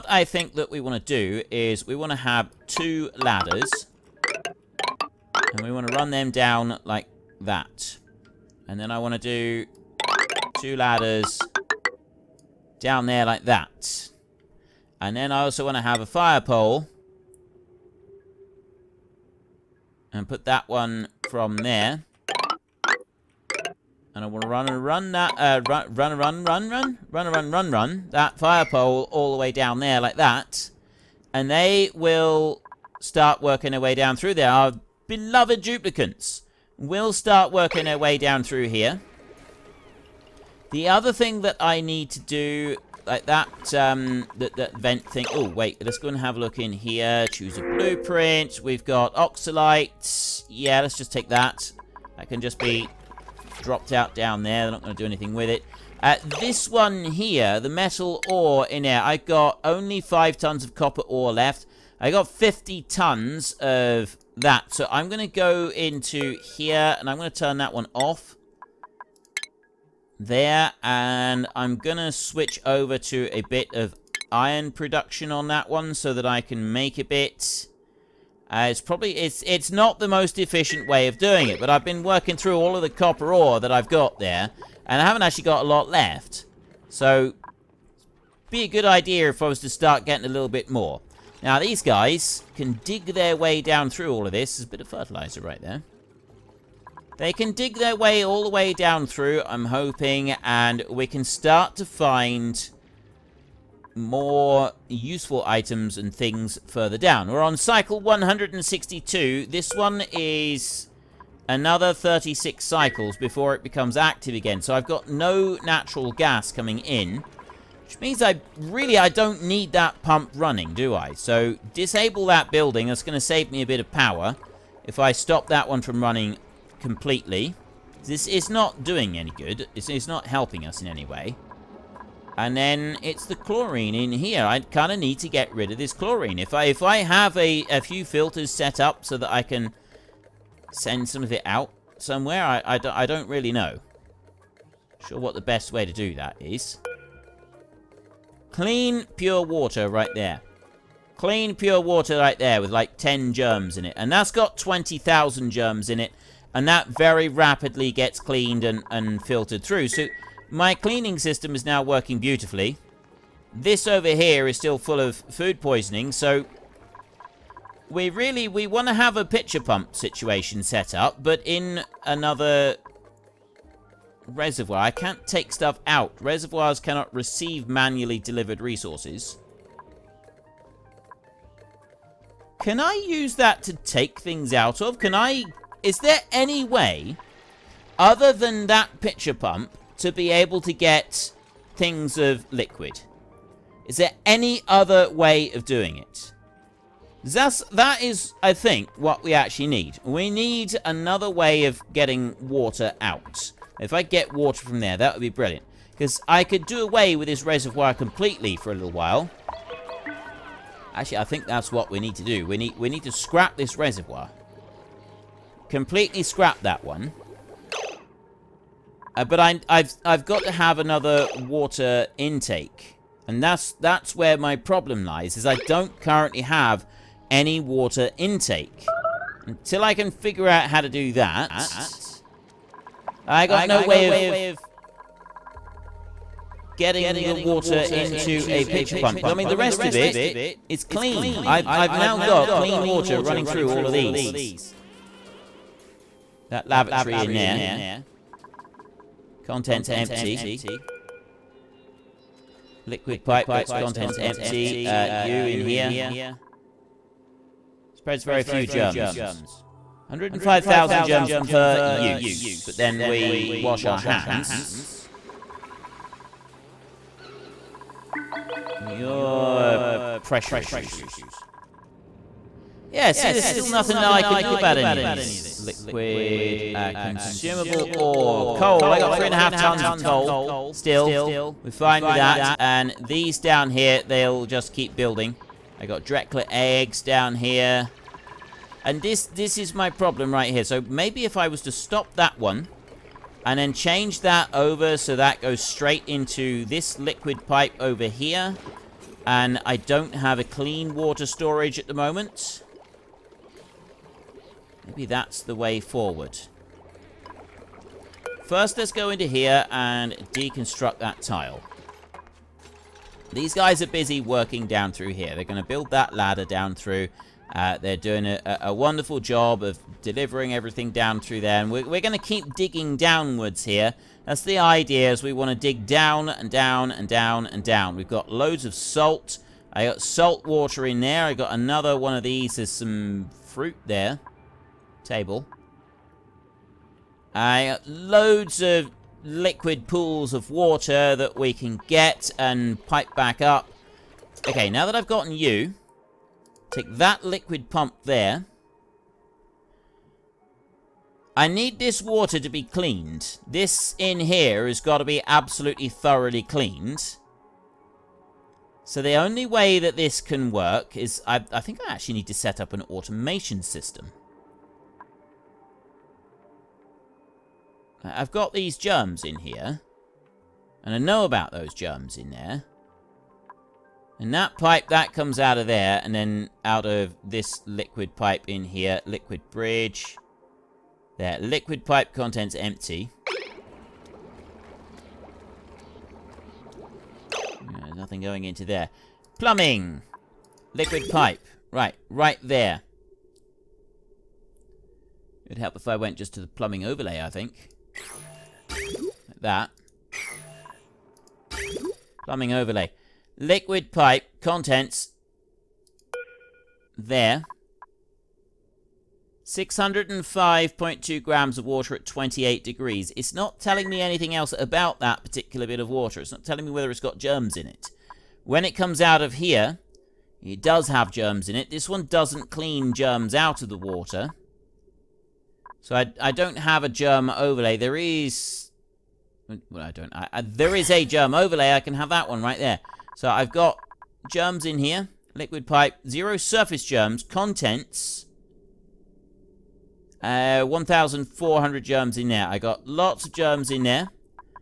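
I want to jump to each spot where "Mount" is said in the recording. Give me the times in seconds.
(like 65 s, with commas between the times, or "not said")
not said.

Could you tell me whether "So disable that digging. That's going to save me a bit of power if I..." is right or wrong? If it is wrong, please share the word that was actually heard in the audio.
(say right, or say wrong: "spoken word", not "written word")
wrong: "building", not "digging".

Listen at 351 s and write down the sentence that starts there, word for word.
I need this water to be cleaned.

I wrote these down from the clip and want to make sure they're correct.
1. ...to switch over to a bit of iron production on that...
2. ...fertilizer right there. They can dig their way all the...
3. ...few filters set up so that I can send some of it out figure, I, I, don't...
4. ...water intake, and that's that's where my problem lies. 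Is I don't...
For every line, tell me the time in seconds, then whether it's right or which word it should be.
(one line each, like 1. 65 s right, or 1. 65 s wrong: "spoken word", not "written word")
1. 71 s right
2. 94 s right
3. 137 s wrong: "somewhere", not "figure"
4. 221 s right.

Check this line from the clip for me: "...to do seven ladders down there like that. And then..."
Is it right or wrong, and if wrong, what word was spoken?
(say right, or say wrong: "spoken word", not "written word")
wrong: "two", not "seven".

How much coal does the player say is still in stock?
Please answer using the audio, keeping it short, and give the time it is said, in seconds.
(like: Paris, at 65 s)
three and a half tons, at 279 s.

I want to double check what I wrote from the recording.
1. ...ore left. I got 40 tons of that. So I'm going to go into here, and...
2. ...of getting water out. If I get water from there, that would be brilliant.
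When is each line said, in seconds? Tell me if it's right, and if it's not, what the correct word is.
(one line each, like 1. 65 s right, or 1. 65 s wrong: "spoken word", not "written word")
1. 61 s wrong: "50", not "40"
2. 201 s right.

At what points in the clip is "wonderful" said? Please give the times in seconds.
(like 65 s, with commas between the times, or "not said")
318 s.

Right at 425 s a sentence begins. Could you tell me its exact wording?
So I, I don't have a germ overlay.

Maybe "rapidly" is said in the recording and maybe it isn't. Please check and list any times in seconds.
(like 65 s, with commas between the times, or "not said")
157 s.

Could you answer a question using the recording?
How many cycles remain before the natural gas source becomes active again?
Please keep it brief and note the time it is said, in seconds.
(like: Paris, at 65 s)
36, at 111 s.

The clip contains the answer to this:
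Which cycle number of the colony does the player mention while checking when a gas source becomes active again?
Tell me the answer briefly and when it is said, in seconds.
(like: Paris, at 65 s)
162, at 108 s.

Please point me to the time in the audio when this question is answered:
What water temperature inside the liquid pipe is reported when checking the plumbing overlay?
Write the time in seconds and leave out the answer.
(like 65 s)
412 s.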